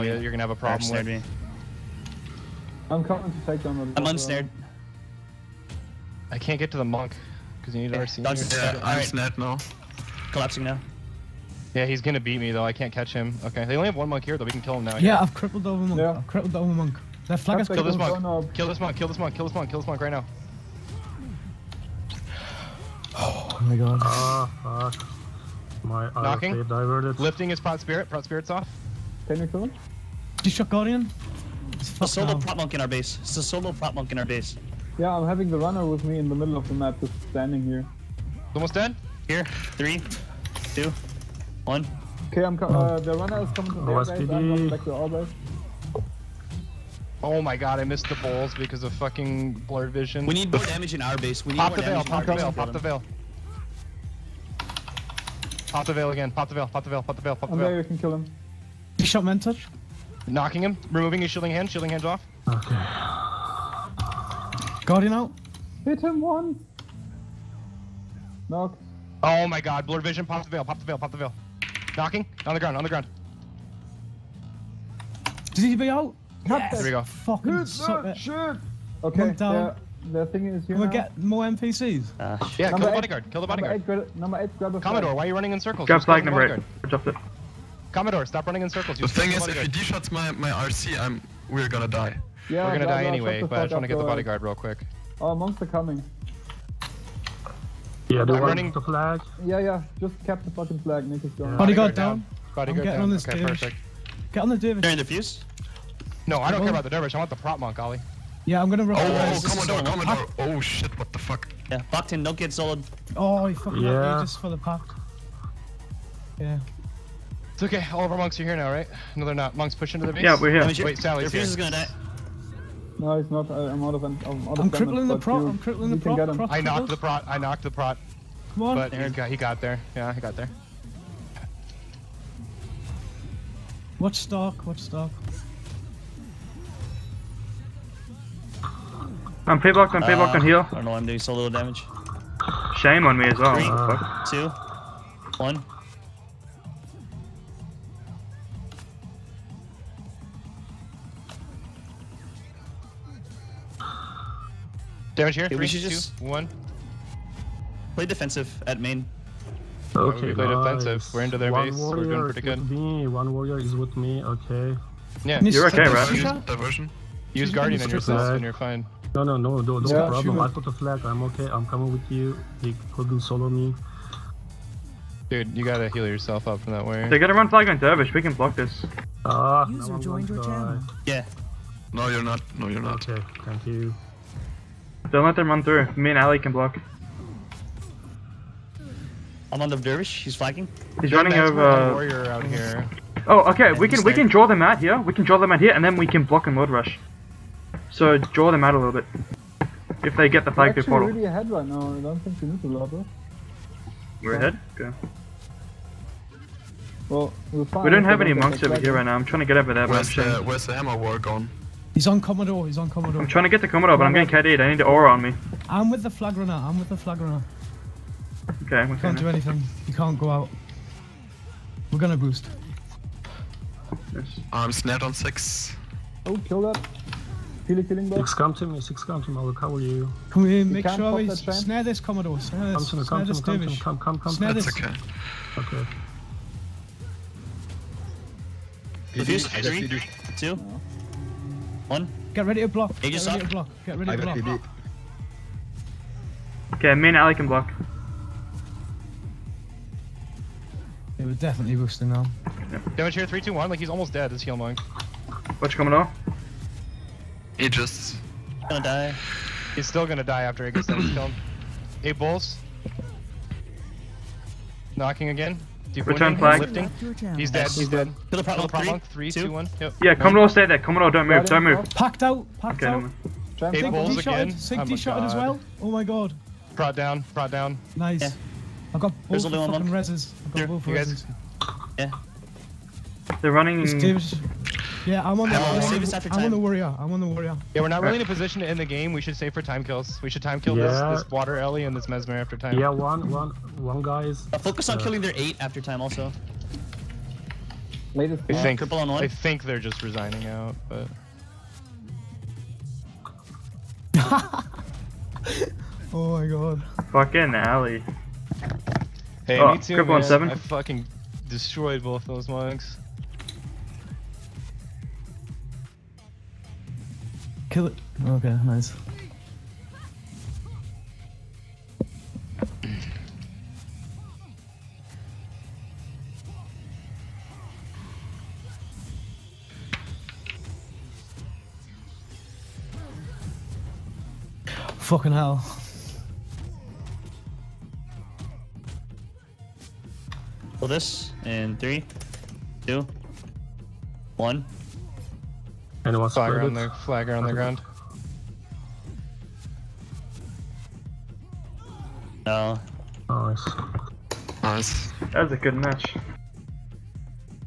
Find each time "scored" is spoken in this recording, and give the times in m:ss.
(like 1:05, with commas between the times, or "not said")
not said.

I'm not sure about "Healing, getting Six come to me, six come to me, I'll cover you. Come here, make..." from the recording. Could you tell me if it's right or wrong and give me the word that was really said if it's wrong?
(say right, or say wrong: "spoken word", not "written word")
wrong: "healing", not "getting".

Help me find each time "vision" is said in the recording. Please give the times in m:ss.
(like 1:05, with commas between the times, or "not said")
0:49, 1:10.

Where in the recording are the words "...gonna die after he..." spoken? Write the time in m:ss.
4:20.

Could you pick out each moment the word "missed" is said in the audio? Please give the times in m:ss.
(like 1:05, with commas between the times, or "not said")
0:47.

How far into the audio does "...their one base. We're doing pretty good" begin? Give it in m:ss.
2:41.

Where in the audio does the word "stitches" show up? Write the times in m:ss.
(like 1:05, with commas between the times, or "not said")
not said.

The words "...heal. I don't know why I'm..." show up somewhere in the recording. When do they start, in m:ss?
2:20.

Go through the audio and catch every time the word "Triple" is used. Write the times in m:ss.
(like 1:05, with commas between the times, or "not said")
4:58.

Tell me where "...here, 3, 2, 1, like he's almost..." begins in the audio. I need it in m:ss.
4:13.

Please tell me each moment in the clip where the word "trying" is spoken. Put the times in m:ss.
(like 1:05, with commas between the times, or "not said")
3:29, 3:33.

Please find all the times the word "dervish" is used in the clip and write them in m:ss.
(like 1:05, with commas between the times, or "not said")
1:46, 2:57, 3:09.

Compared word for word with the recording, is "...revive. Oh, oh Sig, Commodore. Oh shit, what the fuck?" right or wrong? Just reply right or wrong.
wrong.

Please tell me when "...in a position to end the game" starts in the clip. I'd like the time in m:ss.
4:48.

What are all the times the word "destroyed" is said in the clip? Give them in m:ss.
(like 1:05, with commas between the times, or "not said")
5:11.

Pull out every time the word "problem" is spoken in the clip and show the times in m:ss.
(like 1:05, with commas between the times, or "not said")
0:00, 2:50, 4:28.